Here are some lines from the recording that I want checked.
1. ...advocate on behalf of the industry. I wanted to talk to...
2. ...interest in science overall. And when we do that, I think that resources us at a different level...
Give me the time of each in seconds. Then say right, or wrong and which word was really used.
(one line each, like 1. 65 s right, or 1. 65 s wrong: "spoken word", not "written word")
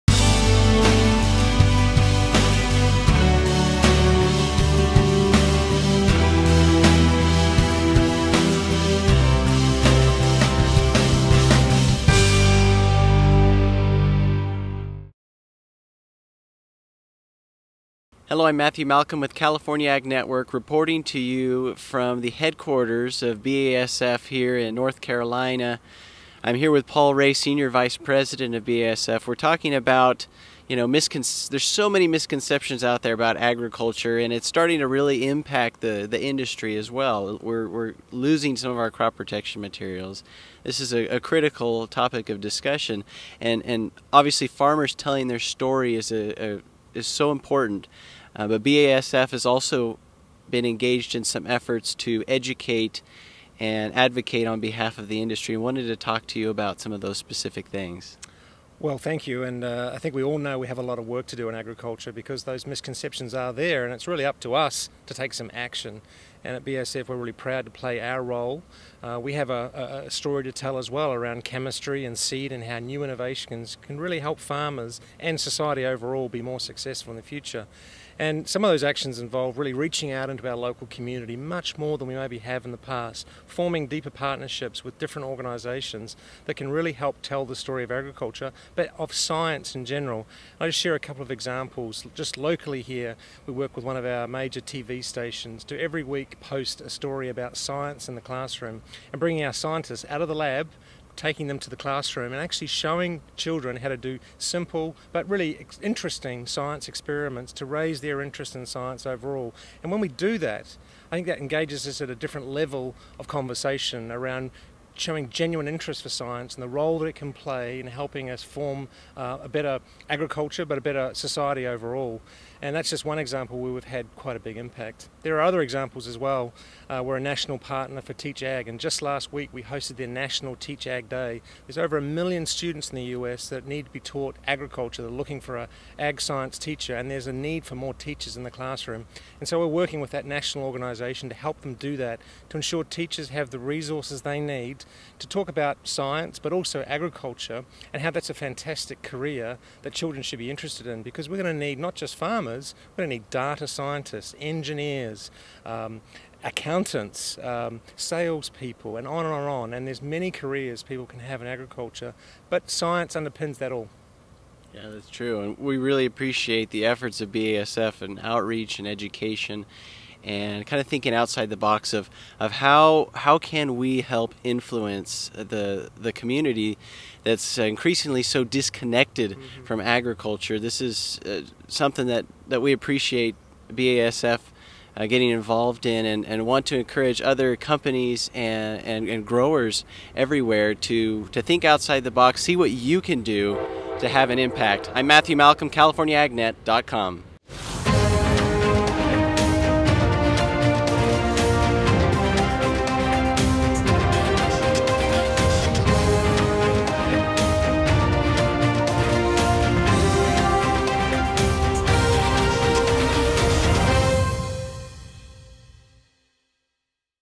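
1. 53 s right
2. 108 s wrong: "engages", not "resources".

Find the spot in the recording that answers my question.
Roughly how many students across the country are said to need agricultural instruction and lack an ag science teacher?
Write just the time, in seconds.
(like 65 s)
131 s.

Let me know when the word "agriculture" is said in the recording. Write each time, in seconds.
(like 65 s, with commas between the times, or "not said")
33 s, 61 s, 87 s, 120 s, 134 s, 146 s, 161 s, 179 s.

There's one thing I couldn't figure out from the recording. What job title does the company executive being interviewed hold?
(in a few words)
Senior Vice President.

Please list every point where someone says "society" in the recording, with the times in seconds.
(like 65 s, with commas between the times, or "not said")
75 s, 121 s.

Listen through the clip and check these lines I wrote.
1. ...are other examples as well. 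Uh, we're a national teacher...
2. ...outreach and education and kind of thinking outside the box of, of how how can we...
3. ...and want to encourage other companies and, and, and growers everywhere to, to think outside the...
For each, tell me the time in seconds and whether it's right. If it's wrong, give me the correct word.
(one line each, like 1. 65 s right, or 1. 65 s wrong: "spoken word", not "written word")
1. 125 s wrong: "partner", not "teacher"
2. 168 s right
3. 186 s right.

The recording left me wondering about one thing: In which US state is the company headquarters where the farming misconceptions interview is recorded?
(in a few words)
North Carolina.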